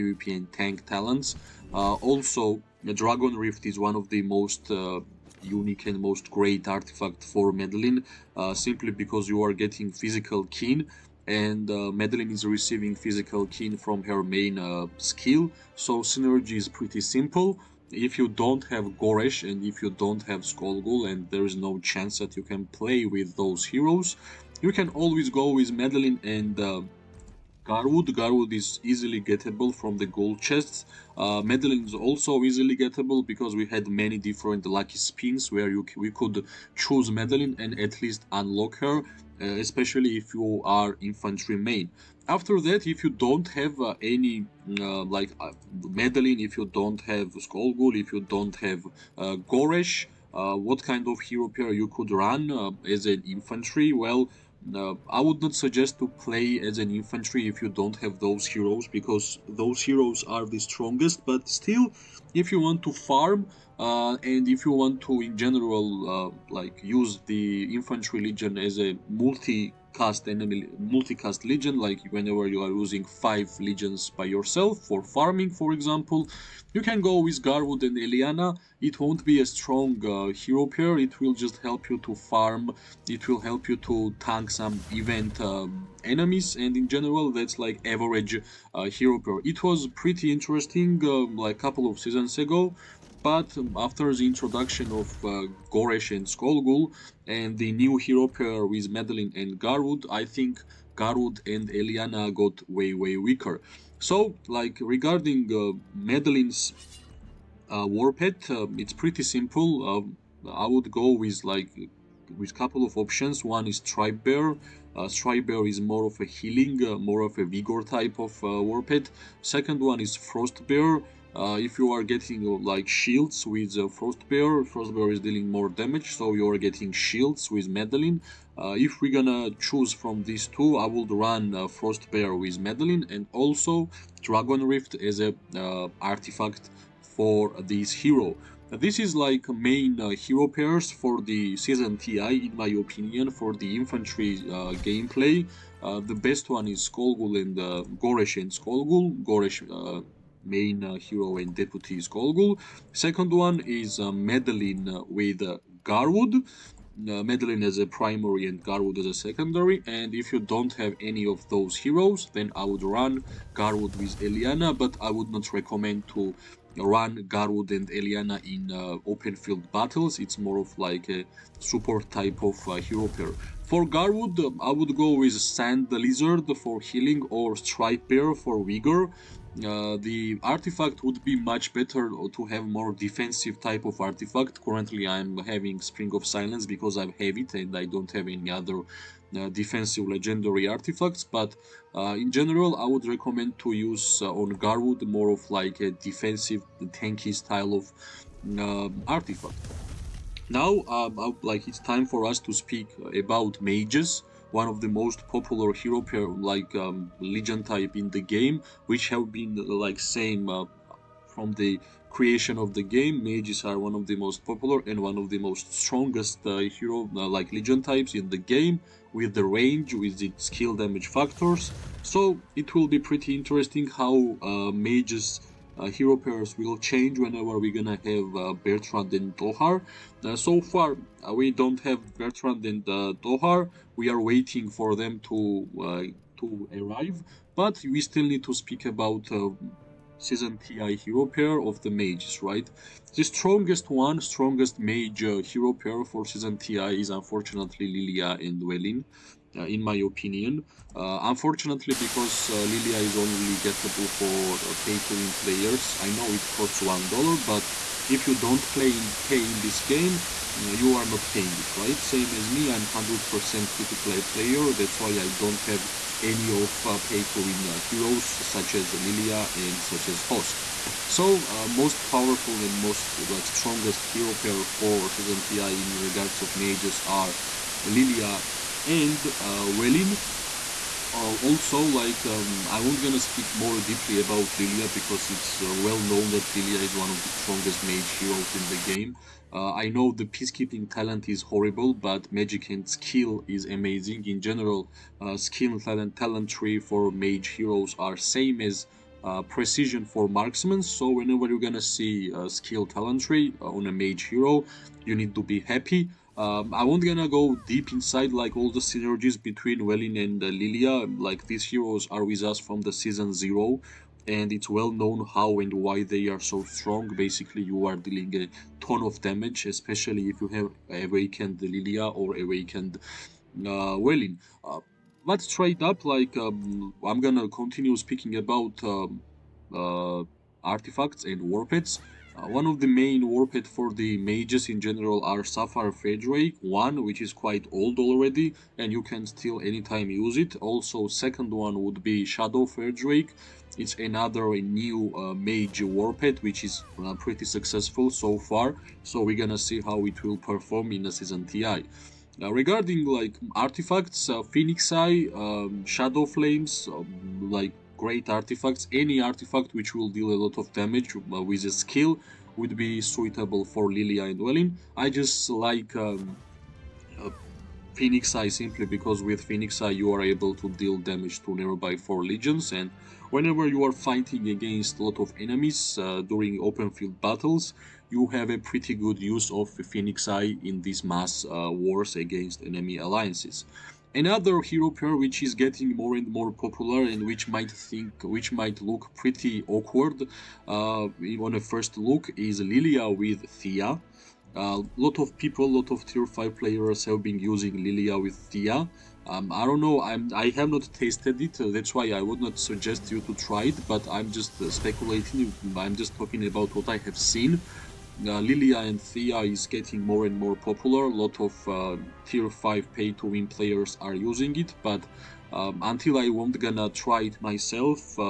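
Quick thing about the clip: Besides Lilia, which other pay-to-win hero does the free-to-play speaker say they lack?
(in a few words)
Hosk.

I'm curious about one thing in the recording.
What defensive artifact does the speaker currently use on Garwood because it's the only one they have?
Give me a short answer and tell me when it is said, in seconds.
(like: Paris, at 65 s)
Spring of Silence, at 185 s.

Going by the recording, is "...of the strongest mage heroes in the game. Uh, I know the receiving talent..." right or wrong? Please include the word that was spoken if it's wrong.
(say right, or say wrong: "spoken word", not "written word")
wrong: "peacekeeping", not "receiving".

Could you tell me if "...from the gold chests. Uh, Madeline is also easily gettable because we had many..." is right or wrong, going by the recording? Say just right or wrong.
right.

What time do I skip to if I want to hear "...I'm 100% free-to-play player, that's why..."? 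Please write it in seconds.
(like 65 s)
262 s.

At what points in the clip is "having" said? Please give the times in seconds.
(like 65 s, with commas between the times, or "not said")
185 s.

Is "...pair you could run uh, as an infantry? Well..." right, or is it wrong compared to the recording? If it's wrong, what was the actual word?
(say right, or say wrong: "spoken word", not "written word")
right.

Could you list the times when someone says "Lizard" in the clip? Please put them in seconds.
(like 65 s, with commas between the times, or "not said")
175 s.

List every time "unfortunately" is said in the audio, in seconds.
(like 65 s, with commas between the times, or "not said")
247 s, 251 s.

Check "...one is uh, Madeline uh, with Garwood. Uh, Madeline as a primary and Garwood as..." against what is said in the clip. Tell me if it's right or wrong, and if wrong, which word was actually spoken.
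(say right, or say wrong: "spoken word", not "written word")
right.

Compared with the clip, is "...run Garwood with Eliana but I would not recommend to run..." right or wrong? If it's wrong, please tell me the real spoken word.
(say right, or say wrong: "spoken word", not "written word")
right.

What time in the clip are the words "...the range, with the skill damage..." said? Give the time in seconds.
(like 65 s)
219 s.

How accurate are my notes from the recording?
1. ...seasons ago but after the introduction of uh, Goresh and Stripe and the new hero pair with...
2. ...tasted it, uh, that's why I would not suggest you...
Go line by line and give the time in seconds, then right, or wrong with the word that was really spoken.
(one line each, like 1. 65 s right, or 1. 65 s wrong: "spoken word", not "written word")
1. 91 s wrong: "Skolgul", not "Stripe"
2. 400 s right.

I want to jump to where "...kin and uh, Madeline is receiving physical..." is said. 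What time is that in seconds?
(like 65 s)
10 s.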